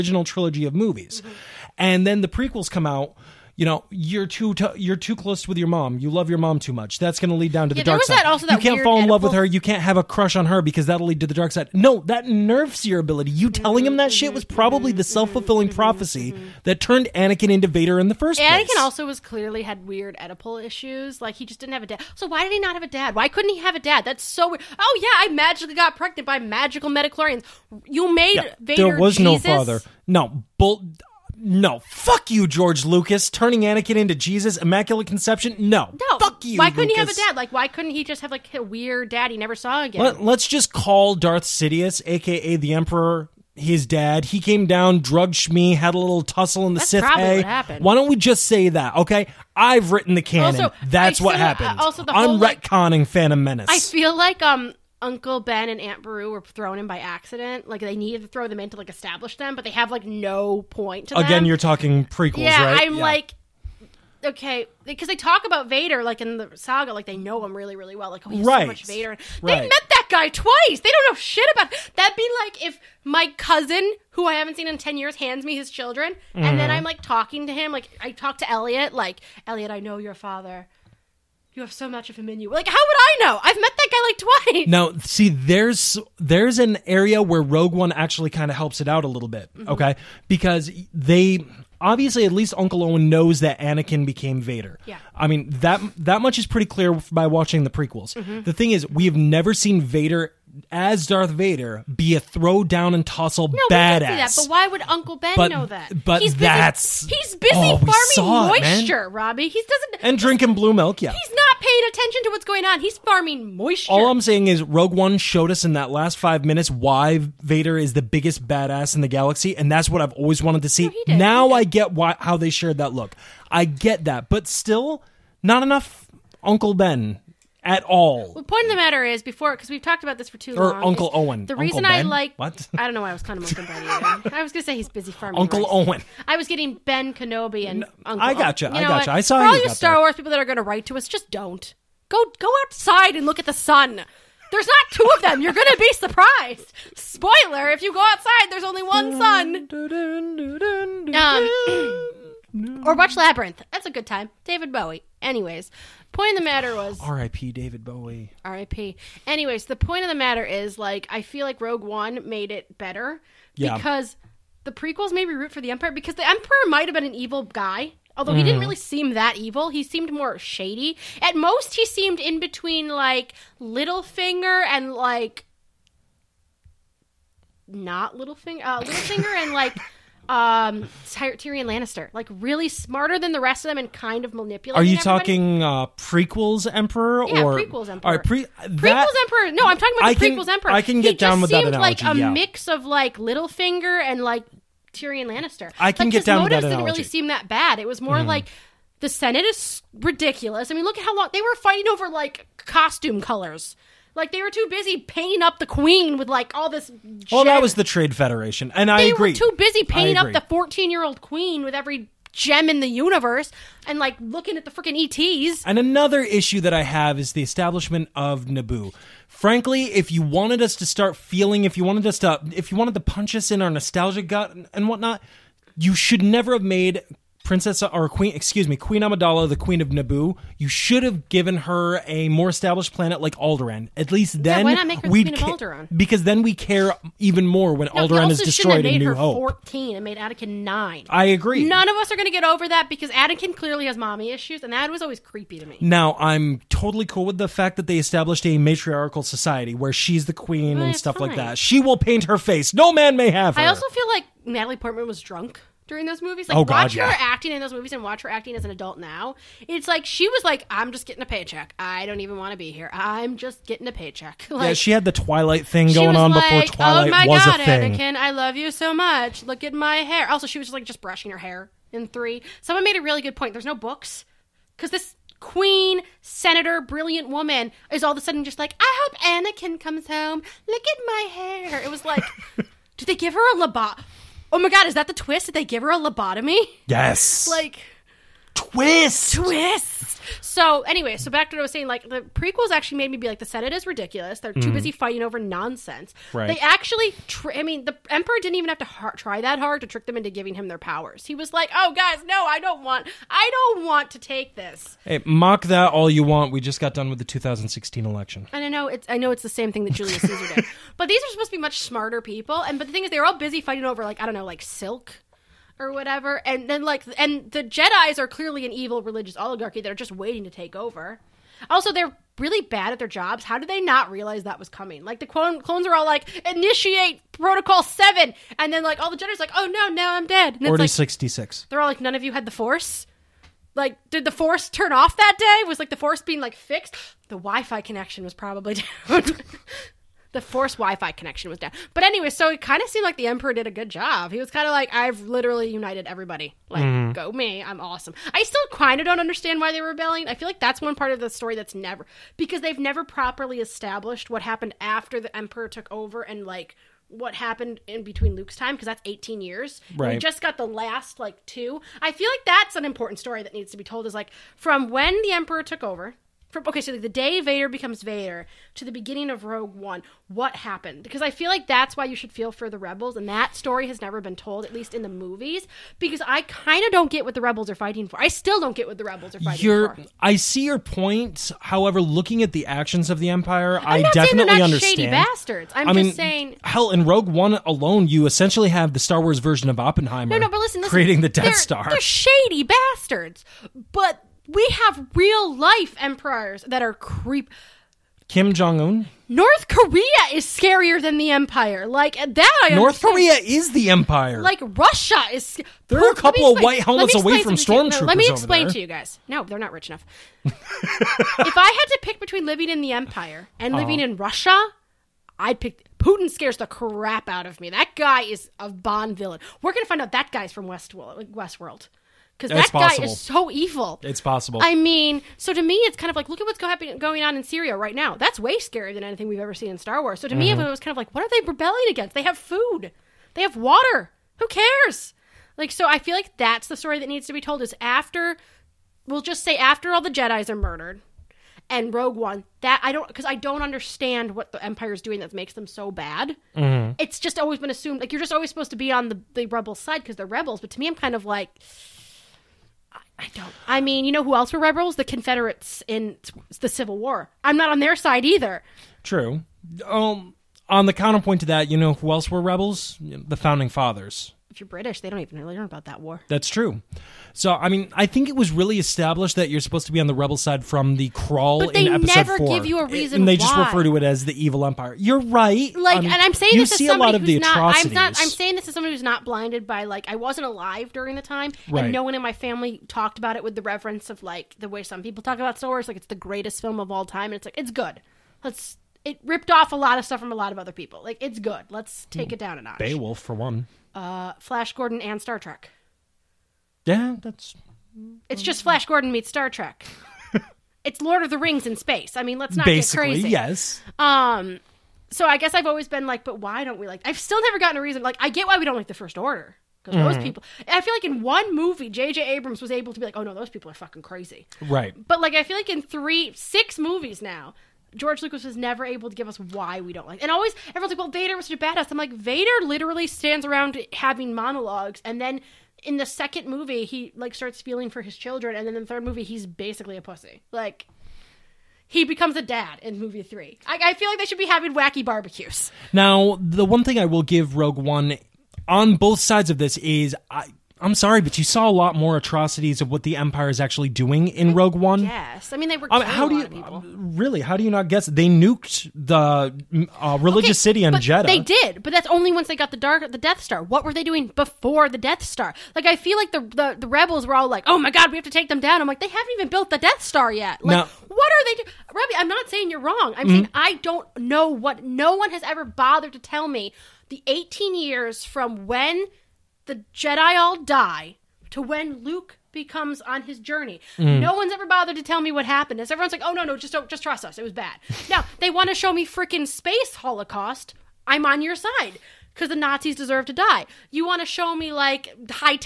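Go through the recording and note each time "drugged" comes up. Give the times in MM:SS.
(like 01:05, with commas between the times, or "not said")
00:44.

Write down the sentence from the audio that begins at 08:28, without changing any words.
Like, I get why we don't like the First Order because mm.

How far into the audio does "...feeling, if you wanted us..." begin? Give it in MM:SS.
03:41.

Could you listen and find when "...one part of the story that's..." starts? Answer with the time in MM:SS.
05:50.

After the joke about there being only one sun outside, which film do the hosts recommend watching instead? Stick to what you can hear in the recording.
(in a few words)
Labyrinth.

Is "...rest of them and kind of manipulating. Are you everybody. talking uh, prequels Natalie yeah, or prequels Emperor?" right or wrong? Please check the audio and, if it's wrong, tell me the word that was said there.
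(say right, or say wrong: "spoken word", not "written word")
wrong: "Emperor", not "Natalie".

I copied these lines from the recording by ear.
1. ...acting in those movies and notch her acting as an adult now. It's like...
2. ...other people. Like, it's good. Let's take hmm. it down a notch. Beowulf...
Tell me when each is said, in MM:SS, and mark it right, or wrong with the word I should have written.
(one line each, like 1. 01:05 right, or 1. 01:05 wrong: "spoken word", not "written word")
1. 04:17 wrong: "watch", not "notch"
2. 08:10 right.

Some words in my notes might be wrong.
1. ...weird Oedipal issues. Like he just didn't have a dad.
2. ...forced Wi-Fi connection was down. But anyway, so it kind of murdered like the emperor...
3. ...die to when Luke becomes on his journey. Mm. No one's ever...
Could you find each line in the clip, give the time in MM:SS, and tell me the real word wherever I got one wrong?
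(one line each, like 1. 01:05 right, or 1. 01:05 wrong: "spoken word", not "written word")
1. 00:19 right
2. 05:40 wrong: "seemed", not "murdered"
3. 09:30 right.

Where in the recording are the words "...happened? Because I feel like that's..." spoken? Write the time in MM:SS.
06:10.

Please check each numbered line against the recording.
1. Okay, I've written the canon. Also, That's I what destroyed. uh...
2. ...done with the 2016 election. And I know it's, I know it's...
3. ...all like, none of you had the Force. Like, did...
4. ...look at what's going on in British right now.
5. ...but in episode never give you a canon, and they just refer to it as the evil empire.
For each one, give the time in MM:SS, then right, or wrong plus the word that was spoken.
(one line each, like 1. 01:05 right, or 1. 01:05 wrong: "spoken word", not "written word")
1. 00:48 wrong: "happened", not "destroyed"
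2. 05:06 right
3. 05:31 right
4. 07:06 wrong: "Syria", not "British"
5. 07:51 wrong: "reason", not "canon".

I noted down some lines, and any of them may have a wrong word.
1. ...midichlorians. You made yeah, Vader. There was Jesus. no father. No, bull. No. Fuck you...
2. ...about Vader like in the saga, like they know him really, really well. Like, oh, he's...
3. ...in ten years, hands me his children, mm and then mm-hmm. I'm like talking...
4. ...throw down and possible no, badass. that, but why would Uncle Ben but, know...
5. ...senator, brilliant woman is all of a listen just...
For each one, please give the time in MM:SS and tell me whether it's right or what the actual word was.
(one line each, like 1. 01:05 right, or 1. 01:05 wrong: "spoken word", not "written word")
1. 00:26 right
2. 01:05 right
3. 01:14 right
4. 01:42 wrong: "tussle", not "possible"
5. 04:36 wrong: "sudden", not "listen".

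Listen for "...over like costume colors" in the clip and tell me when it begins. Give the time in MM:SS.
03:21.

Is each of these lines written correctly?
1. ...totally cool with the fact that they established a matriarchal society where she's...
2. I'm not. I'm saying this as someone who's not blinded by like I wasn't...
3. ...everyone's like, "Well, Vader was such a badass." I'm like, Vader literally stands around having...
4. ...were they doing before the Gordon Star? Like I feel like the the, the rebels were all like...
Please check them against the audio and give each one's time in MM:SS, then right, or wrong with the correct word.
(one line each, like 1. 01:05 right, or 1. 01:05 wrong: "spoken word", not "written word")
1. 04:06 right
2. 07:57 right
3. 08:40 right
4. 09:13 wrong: "Death", not "Gordon".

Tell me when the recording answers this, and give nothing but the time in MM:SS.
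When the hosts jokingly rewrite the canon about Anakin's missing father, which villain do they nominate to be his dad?
00:41.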